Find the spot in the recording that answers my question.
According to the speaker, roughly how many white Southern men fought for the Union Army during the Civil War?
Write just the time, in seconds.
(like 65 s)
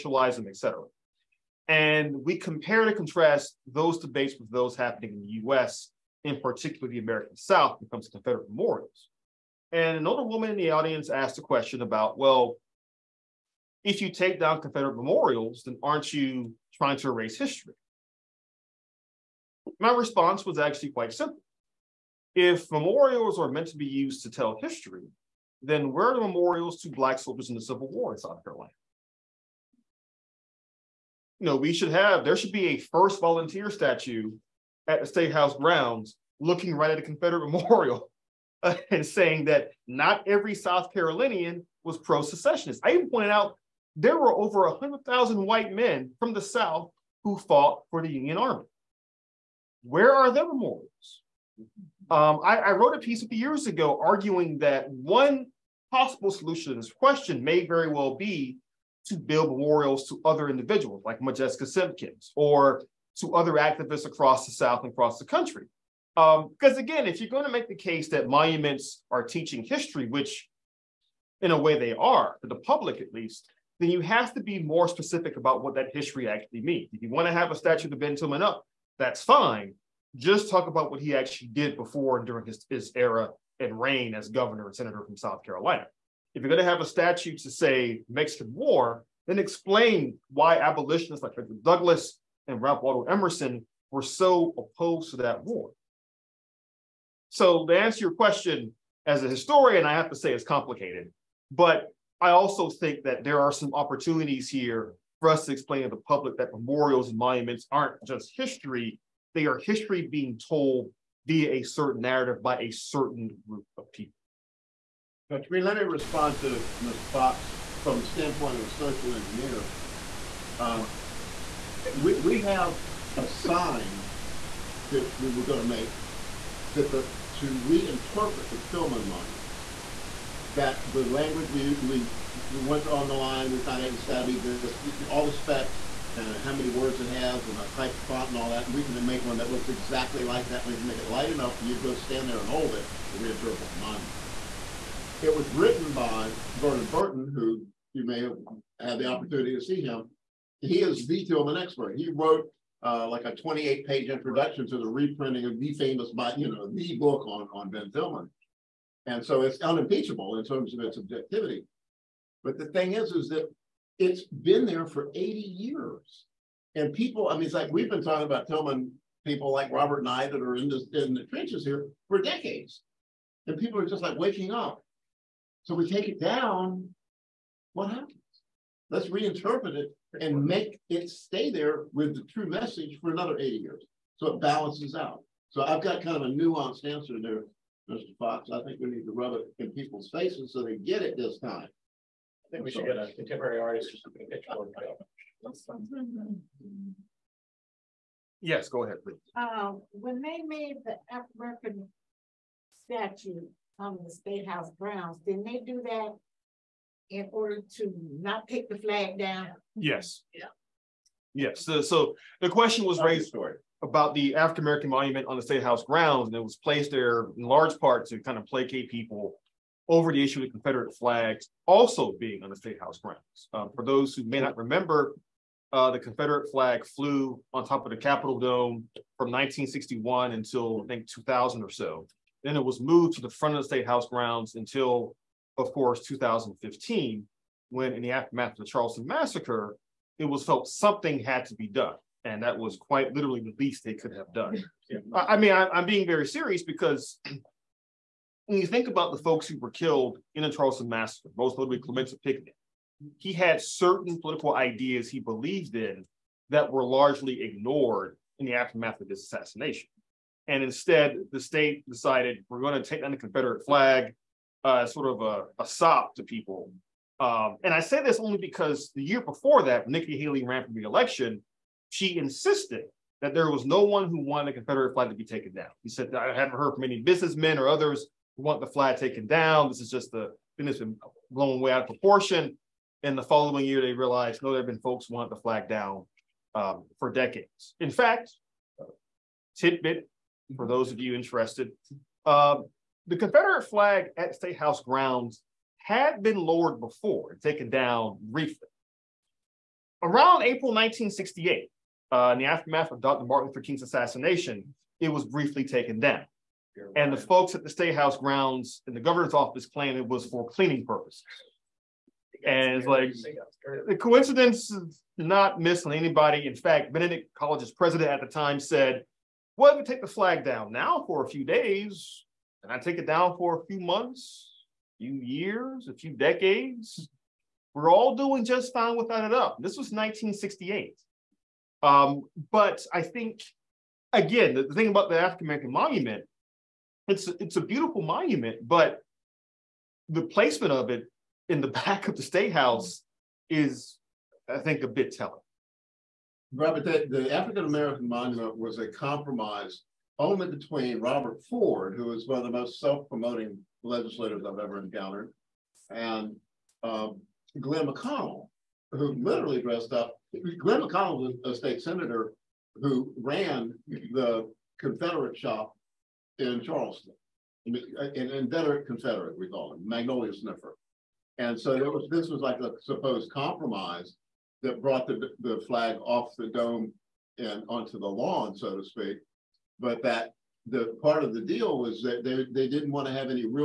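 44 s.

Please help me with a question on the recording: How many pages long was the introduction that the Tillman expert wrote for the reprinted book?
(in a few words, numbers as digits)
28.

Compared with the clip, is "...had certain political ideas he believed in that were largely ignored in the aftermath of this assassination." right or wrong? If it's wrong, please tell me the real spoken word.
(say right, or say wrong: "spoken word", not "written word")
right.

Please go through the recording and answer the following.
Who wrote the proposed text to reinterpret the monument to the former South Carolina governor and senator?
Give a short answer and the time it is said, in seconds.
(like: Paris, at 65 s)
Vernon Burton, at 146 s.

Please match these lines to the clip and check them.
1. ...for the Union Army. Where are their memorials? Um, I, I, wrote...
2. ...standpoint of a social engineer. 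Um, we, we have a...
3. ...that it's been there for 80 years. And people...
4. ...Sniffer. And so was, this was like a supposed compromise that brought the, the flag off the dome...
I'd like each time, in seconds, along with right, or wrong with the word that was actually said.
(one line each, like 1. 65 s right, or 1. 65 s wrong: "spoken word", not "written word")
1. 47 s right
2. 118 s right
3. 163 s right
4. 370 s right.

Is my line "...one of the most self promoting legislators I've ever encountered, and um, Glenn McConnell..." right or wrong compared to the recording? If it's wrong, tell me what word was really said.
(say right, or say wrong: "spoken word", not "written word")
right.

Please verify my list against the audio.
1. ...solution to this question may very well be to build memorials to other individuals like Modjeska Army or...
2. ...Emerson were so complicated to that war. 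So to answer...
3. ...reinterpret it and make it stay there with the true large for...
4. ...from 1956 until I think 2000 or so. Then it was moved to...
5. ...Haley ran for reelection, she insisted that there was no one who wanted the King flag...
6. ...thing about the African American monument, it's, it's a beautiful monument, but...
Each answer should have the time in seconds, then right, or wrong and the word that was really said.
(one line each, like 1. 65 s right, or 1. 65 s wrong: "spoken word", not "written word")
1. 56 s wrong: "Simkins", not "Army"
2. 93 s wrong: "opposed", not "complicated"
3. 179 s wrong: "message", not "large"
4. 229 s wrong: "1961", not "1956"
5. 270 s wrong: "Confederate", not "King"
6. 334 s right.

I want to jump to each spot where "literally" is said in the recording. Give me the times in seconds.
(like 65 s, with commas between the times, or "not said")
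243 s, 359 s.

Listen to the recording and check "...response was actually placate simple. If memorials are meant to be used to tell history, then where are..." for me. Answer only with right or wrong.
wrong.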